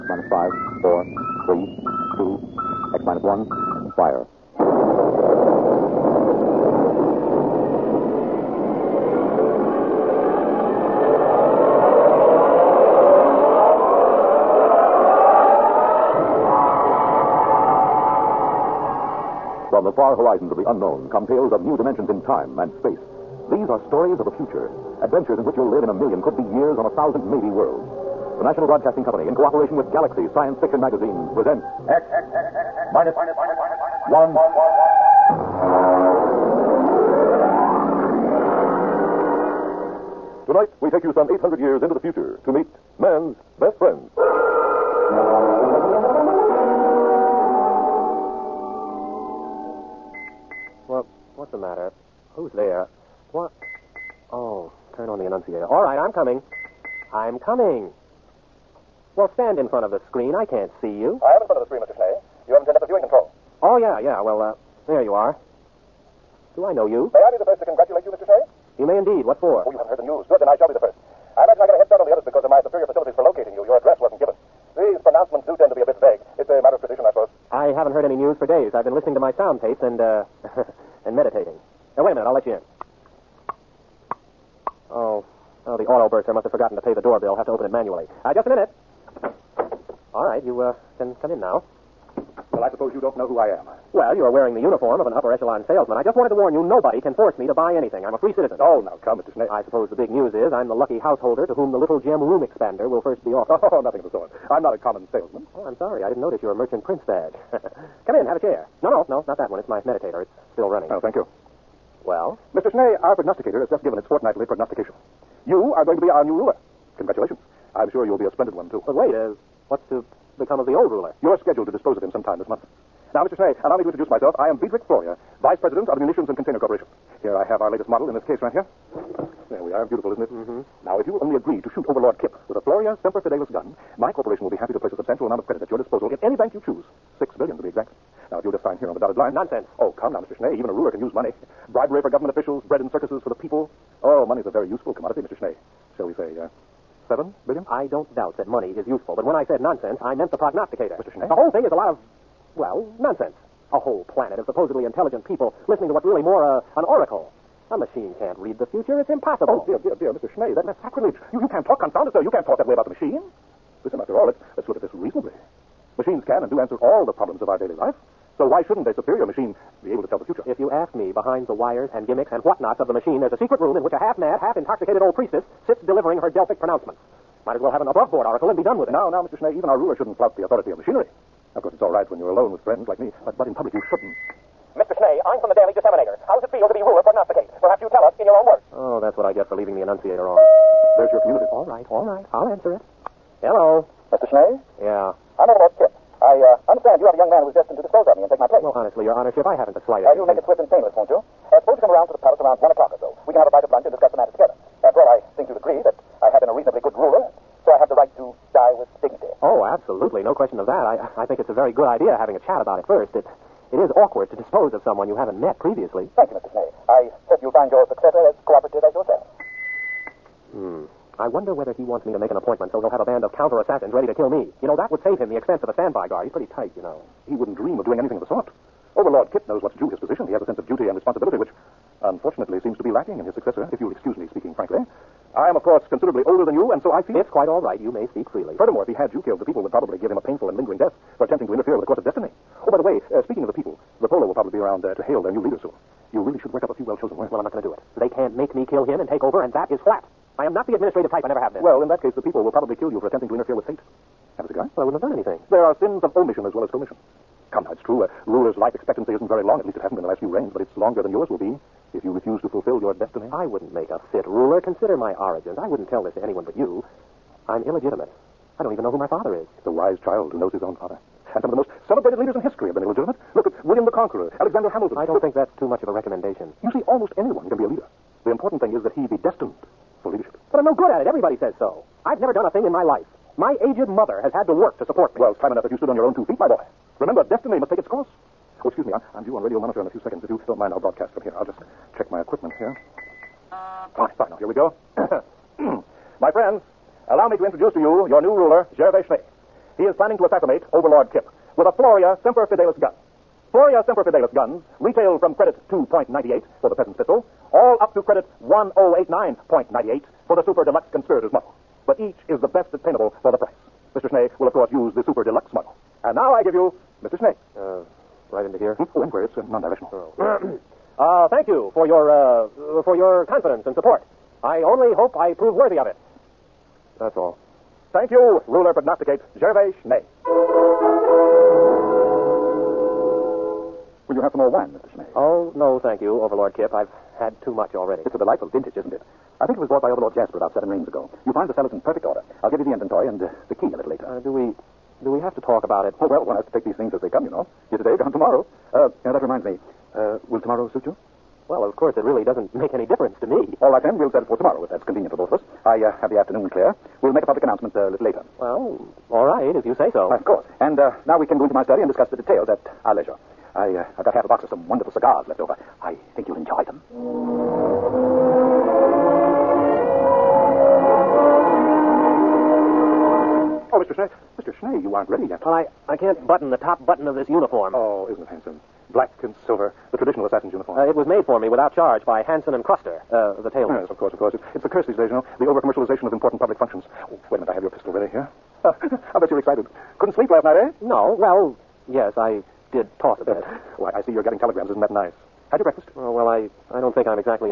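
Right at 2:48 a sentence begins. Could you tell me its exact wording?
So why shouldn't a superior machine be able to tell the future?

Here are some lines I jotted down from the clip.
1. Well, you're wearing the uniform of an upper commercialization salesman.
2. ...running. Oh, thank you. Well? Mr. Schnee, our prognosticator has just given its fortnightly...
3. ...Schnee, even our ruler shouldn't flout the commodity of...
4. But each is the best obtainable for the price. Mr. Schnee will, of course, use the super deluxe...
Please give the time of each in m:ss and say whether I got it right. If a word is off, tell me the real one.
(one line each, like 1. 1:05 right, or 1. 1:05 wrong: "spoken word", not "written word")
1. 1:33 wrong: "echelon", not "commercialization"
2. 1:50 right
3. 2:59 wrong: "authority", not "commodity"
4. 5:11 right.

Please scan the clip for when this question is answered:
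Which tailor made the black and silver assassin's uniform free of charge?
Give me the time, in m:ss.
6:22.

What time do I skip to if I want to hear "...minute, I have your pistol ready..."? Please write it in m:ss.
6:27.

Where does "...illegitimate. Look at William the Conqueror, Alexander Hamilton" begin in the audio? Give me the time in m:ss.
4:32.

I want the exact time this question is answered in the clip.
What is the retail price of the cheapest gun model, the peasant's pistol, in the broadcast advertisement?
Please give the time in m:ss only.
5:05.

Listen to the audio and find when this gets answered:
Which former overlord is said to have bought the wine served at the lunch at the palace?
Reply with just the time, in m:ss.
5:39.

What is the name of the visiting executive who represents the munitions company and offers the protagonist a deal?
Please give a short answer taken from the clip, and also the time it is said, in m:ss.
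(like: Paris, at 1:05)
Friedrich Floria, at 2:04.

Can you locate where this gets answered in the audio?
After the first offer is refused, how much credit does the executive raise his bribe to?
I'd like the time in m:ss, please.
2:27.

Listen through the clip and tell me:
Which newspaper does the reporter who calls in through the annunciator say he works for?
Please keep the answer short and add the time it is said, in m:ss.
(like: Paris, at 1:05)
Daily Disseminator, at 3:05.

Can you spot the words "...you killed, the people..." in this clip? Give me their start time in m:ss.
3:59.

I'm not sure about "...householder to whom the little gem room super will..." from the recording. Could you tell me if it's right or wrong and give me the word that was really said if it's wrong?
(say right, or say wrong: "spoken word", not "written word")
wrong: "expander", not "super".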